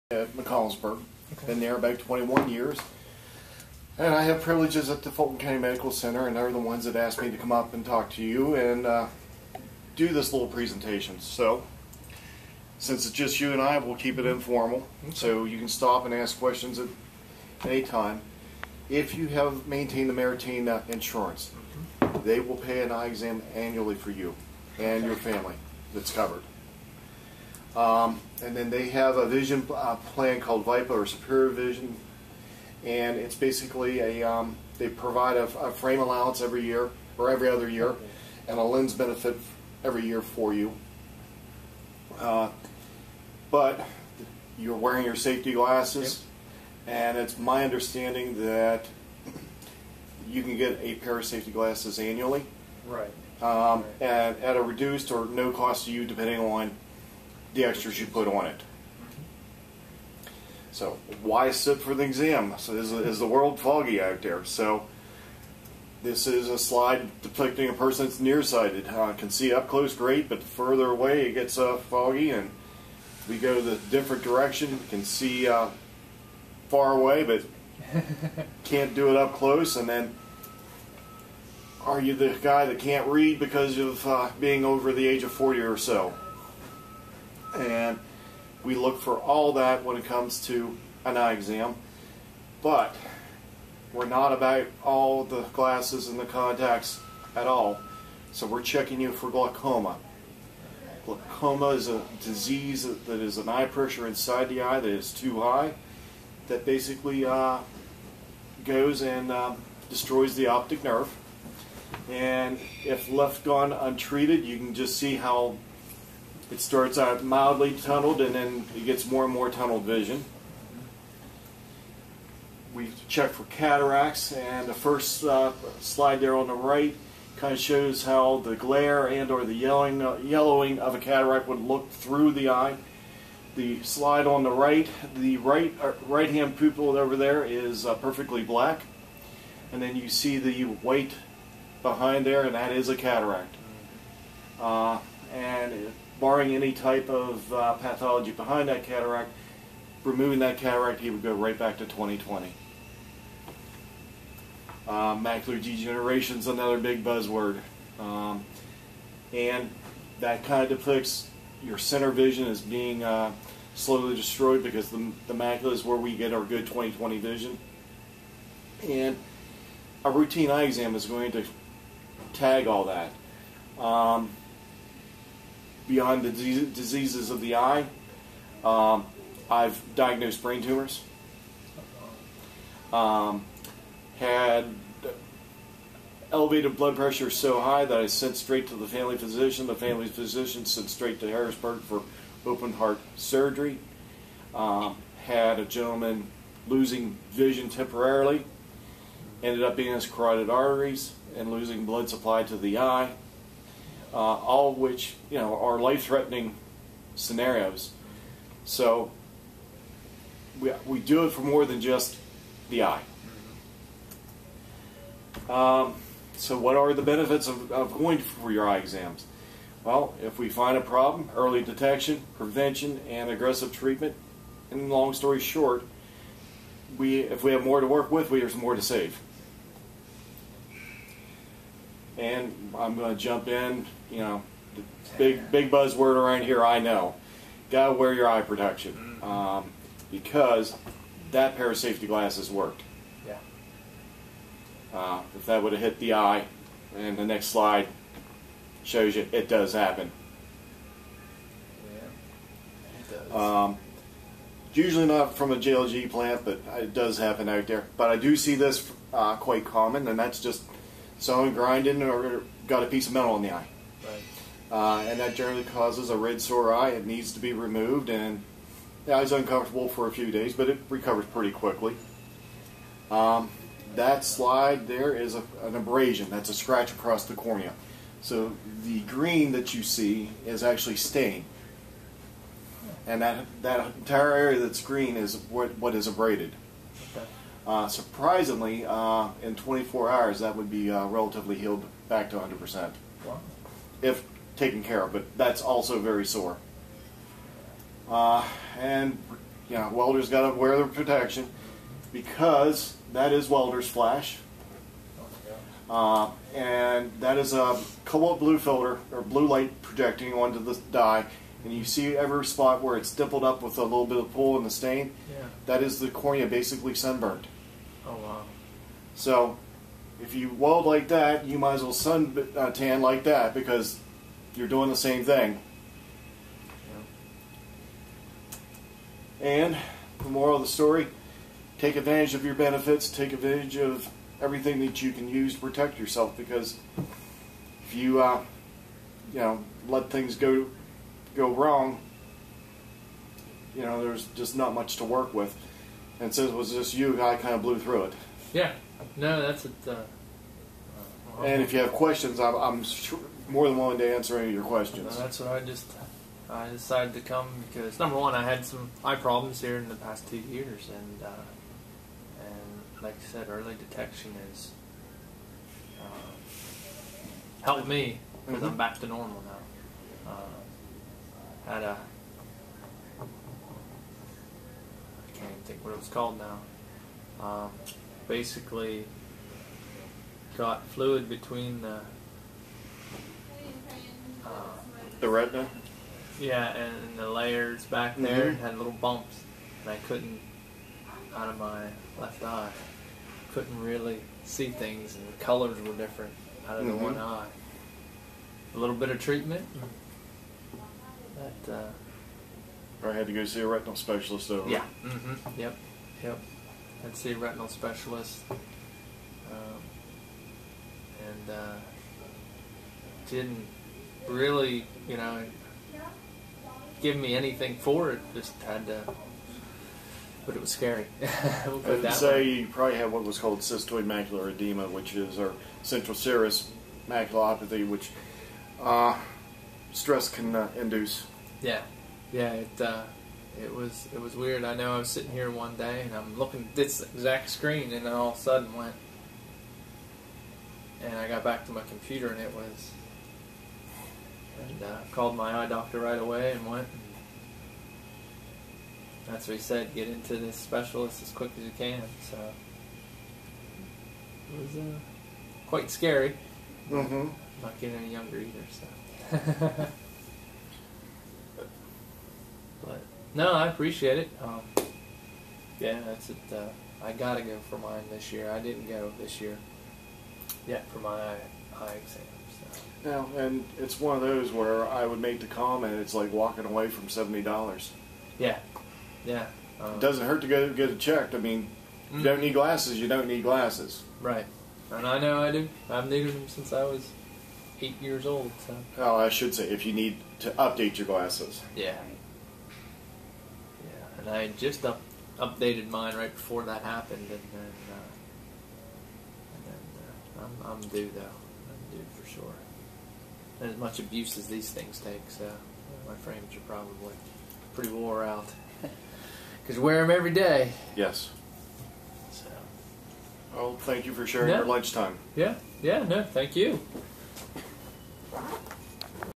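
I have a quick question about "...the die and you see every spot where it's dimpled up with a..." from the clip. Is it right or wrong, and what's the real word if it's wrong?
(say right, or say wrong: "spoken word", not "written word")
right.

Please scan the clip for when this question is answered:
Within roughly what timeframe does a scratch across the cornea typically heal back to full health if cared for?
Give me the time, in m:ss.
4:49.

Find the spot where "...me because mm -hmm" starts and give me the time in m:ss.
6:07.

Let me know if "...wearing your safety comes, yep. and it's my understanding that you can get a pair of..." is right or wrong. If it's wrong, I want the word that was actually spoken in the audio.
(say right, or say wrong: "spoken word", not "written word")
wrong: "glasses", not "comes".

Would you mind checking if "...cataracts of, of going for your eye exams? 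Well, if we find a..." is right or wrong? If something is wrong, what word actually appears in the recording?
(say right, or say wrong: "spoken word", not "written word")
wrong: "benefits", not "cataracts".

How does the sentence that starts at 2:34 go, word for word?
Uh, macular degeneration is another big buzzword.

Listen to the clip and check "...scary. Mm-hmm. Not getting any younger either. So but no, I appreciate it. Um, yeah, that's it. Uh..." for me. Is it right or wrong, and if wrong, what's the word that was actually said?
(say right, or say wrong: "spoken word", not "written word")
right.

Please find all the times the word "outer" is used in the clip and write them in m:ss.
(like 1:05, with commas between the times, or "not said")
not said.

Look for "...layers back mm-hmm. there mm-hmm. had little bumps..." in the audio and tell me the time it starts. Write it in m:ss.
6:27.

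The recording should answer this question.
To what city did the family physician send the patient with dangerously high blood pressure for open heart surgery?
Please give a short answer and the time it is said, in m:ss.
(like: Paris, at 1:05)
Harrisburg, at 3:11.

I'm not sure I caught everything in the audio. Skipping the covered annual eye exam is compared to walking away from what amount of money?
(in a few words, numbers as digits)
$70.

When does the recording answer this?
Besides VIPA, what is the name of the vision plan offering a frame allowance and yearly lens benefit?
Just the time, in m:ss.
0:31.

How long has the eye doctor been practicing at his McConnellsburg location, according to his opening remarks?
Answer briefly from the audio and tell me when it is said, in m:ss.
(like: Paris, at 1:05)
21 years, at 0:01.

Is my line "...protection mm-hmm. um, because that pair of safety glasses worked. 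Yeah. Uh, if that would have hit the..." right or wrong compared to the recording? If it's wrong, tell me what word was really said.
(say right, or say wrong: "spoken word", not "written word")
right.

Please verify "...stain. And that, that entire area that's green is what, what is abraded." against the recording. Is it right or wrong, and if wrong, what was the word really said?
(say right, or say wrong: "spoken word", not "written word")
right.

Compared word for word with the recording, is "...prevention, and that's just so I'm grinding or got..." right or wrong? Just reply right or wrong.
wrong.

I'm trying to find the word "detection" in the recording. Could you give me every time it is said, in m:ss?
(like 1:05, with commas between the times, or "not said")
3:41, 6:03.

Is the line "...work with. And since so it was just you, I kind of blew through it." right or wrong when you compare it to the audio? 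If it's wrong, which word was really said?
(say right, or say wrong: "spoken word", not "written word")
right.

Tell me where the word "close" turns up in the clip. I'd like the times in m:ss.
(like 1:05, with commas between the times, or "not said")
1:09, 1:19.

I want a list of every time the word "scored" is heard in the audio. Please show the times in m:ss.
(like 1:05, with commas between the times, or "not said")
not said.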